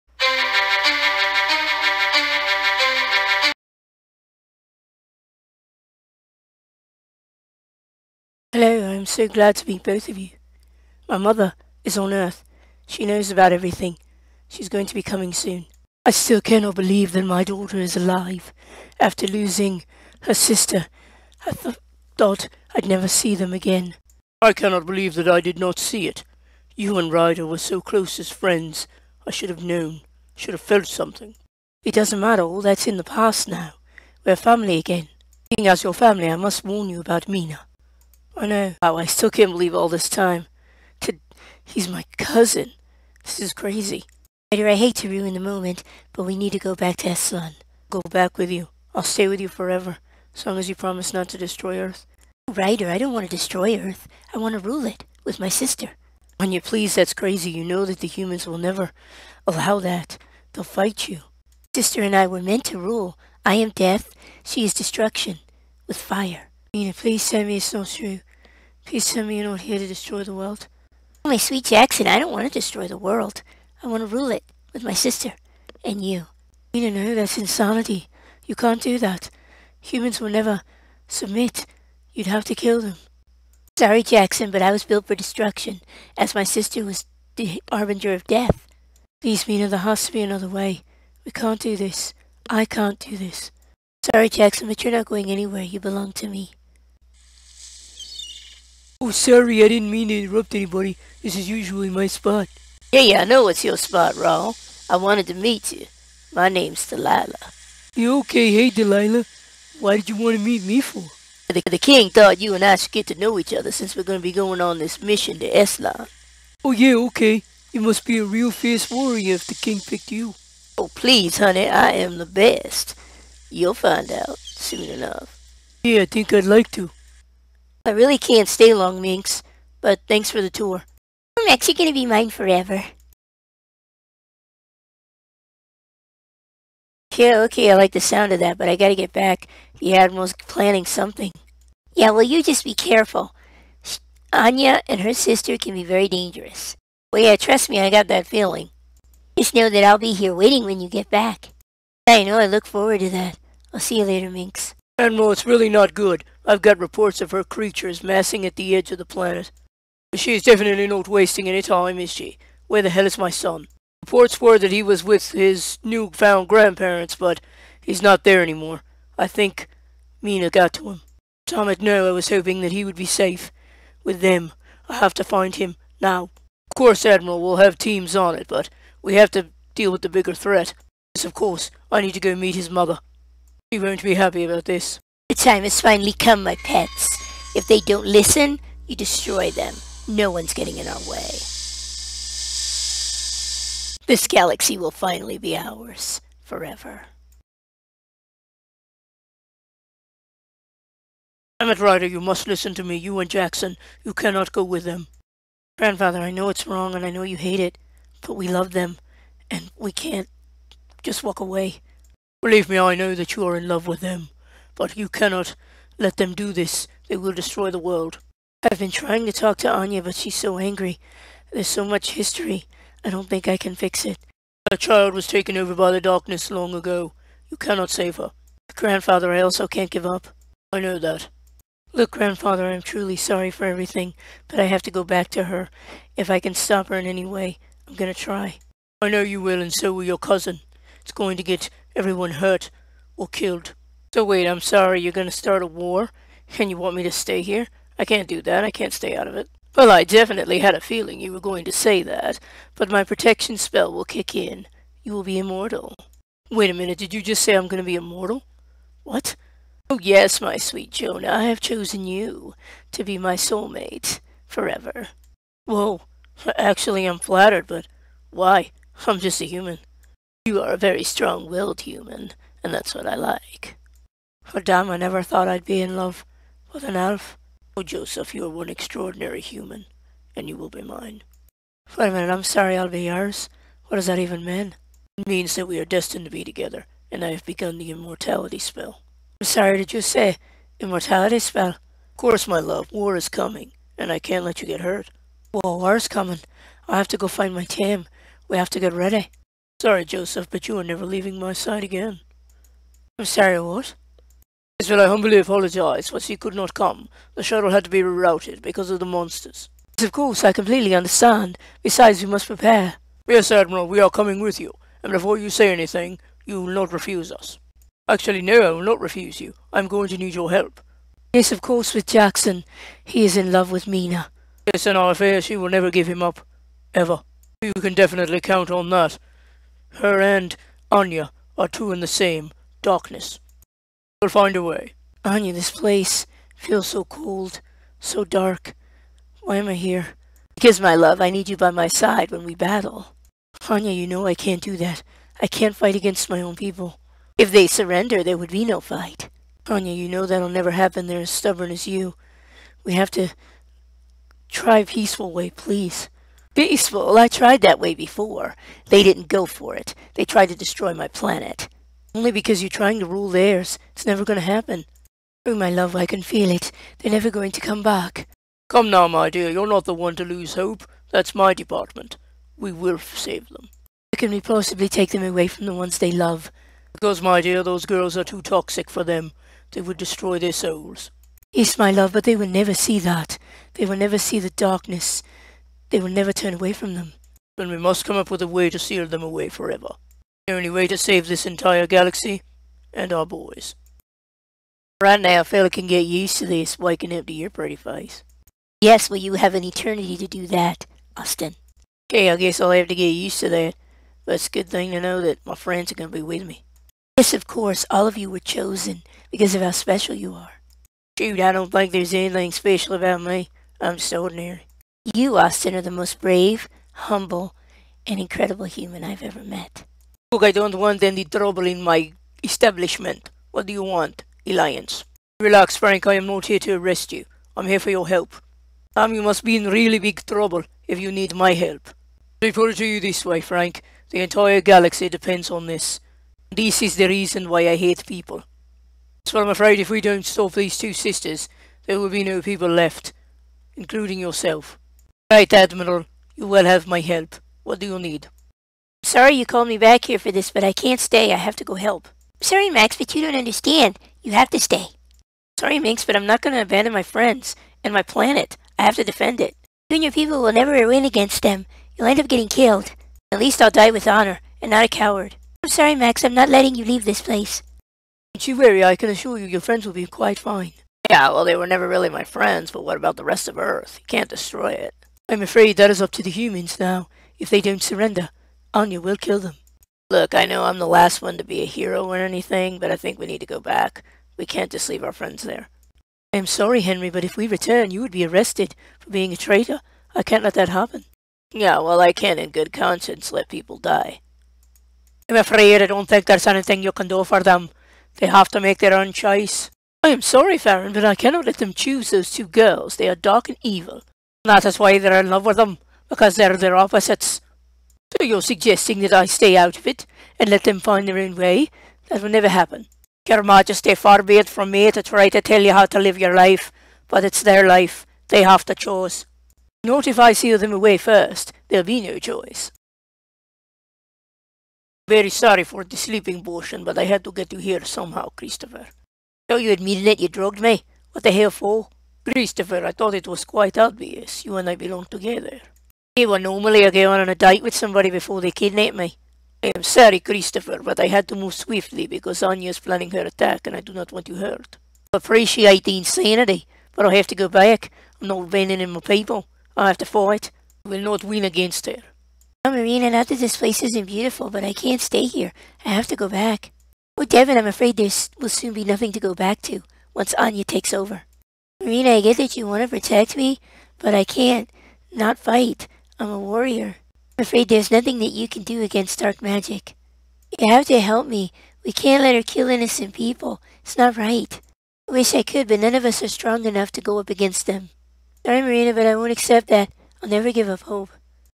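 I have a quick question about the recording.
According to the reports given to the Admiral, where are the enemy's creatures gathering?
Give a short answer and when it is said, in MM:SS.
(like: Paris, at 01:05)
edge of the planet, at 02:38.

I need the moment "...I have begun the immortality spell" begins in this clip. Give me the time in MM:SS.
04:47.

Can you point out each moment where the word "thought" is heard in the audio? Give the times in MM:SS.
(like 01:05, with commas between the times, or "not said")
00:22, 01:52, 04:35, 08:52.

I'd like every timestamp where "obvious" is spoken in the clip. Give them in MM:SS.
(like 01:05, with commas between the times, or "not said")
08:53.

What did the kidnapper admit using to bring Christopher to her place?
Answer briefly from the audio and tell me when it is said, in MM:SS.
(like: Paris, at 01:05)
sleeping potion, at 08:45.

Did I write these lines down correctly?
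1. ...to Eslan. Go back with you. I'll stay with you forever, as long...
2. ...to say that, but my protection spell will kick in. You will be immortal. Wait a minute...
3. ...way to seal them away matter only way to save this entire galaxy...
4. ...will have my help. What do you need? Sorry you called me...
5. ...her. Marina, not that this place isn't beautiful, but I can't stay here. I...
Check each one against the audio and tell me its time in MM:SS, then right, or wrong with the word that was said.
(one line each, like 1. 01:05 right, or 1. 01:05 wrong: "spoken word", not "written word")
1. 00:46 right
2. 04:11 right
3. 06:28 wrong: "forever", not "matter"
4. 07:26 right
5. 09:11 right.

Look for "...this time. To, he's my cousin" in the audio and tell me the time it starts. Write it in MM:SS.
00:39.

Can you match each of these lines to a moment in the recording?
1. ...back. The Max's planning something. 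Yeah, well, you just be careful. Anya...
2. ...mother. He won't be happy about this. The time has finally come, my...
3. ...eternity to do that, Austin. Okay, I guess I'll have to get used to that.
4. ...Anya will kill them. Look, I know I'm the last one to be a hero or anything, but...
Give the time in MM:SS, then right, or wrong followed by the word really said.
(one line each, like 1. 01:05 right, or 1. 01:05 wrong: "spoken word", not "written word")
1. 02:19 wrong: "Admiral", not "Max"
2. 03:02 right
3. 06:39 right
4. 07:58 right.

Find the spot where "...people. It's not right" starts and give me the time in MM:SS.
09:33.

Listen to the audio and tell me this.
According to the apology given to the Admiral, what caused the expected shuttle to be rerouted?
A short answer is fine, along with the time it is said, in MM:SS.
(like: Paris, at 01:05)
the monsters, at 05:08.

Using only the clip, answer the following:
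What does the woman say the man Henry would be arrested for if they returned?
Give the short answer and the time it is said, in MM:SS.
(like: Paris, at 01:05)
being a traitor, at 08:09.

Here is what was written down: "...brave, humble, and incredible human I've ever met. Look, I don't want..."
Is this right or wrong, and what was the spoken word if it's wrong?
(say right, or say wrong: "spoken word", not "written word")
right.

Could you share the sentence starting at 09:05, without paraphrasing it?
I appreciate the insanity, but I have to go back.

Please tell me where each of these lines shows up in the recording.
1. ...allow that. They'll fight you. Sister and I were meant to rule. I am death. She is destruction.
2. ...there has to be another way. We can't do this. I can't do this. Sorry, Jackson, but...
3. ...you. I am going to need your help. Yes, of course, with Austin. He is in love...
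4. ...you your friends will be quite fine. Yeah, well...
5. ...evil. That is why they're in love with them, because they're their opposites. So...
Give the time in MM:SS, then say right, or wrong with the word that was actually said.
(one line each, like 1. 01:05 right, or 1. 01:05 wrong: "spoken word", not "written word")
1. 00:59 right
2. 01:29 right
3. 05:19 wrong: "Jackson", not "Austin"
4. 07:49 right
5. 08:23 right.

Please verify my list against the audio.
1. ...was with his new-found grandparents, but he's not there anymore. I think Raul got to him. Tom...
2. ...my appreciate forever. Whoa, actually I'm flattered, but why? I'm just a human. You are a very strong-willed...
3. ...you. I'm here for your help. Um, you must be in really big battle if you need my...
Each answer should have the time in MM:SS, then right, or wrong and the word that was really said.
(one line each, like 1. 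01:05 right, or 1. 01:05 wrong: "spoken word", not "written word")
1. 02:44 wrong: "Mina", not "Raul"
2. 04:23 wrong: "soulmate", not "appreciate"
3. 07:07 wrong: "trouble", not "battle".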